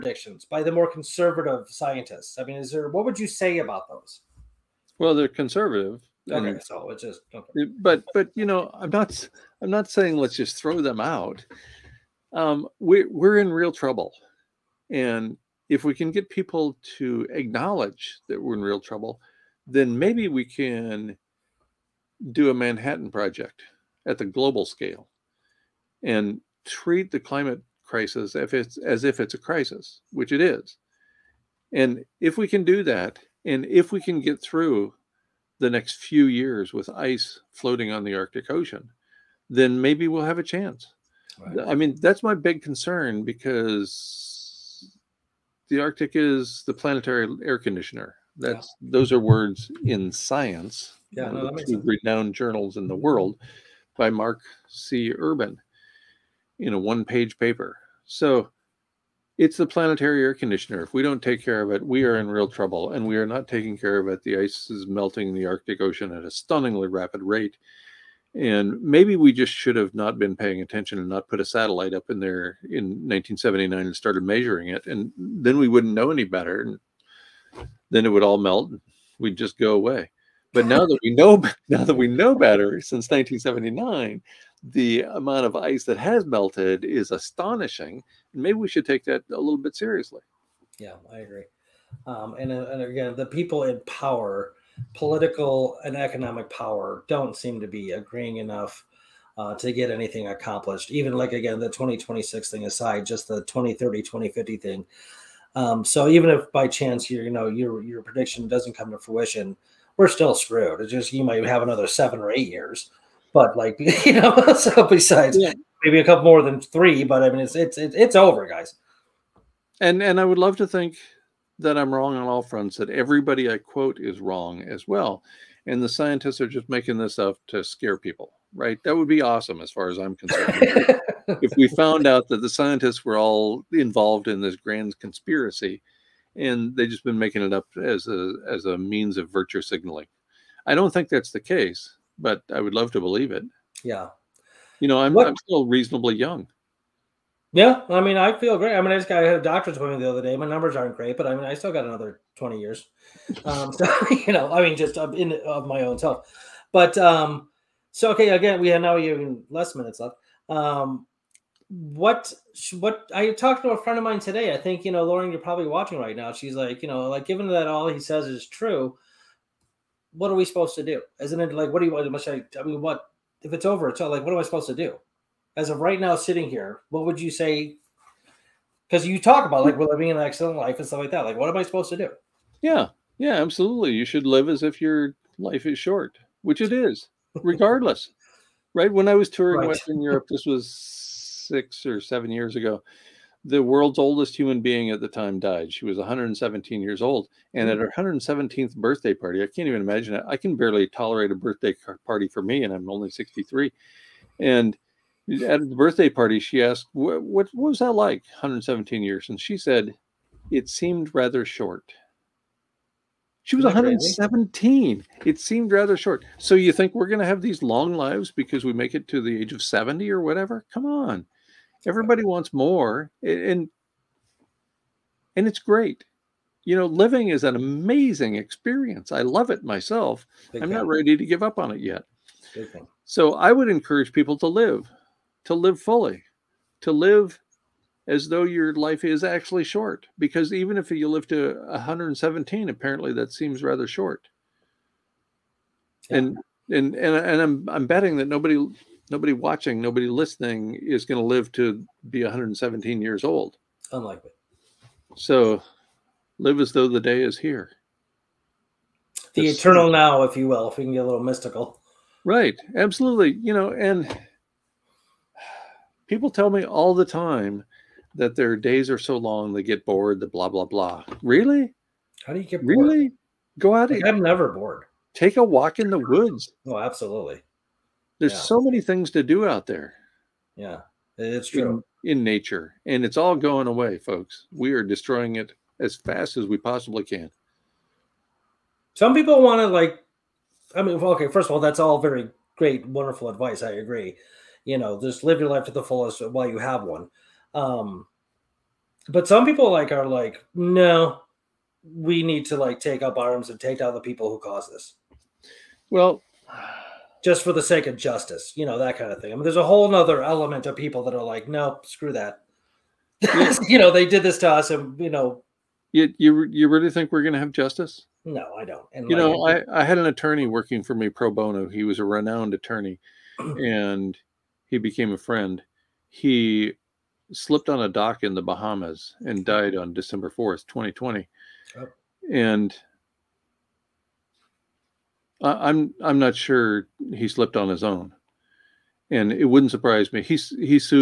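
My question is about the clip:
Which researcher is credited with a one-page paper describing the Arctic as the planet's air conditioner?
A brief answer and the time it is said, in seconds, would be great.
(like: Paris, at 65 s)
Mark C. Urban, at 54 s.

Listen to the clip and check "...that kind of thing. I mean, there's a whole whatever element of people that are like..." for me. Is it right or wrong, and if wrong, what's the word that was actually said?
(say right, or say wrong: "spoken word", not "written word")
wrong: "nother", not "whatever".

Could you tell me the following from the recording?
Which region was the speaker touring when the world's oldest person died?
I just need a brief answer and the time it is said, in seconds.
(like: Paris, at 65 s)
Western Europe, at 189 s.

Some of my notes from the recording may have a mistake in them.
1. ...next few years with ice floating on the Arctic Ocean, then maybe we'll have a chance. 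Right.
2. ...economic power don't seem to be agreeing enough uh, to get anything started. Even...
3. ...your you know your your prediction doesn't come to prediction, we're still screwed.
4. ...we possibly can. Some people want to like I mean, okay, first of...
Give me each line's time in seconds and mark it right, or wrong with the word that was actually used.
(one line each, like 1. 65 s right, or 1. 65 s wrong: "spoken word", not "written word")
1. 35 s right
2. 95 s wrong: "accomplished", not "started"
3. 107 s wrong: "fruition", not "prediction"
4. 286 s right.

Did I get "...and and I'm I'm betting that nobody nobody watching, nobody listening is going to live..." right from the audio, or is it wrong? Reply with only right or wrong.
right.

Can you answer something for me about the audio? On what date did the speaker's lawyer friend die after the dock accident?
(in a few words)
December 4th, 2020.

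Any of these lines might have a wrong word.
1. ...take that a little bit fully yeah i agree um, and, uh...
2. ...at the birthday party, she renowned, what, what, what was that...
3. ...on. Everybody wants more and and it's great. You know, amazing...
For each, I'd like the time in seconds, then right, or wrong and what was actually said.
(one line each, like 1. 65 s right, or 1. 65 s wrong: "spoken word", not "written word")
1. 88 s wrong: "seriously", not "fully"
2. 205 s wrong: "asked", not "renowned"
3. 220 s wrong: "living", not "amazing".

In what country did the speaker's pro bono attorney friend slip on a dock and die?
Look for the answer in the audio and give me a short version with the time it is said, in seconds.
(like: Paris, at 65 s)
the Bahamas, at 328 s.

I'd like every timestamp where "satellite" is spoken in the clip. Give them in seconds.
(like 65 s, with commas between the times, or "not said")
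71 s.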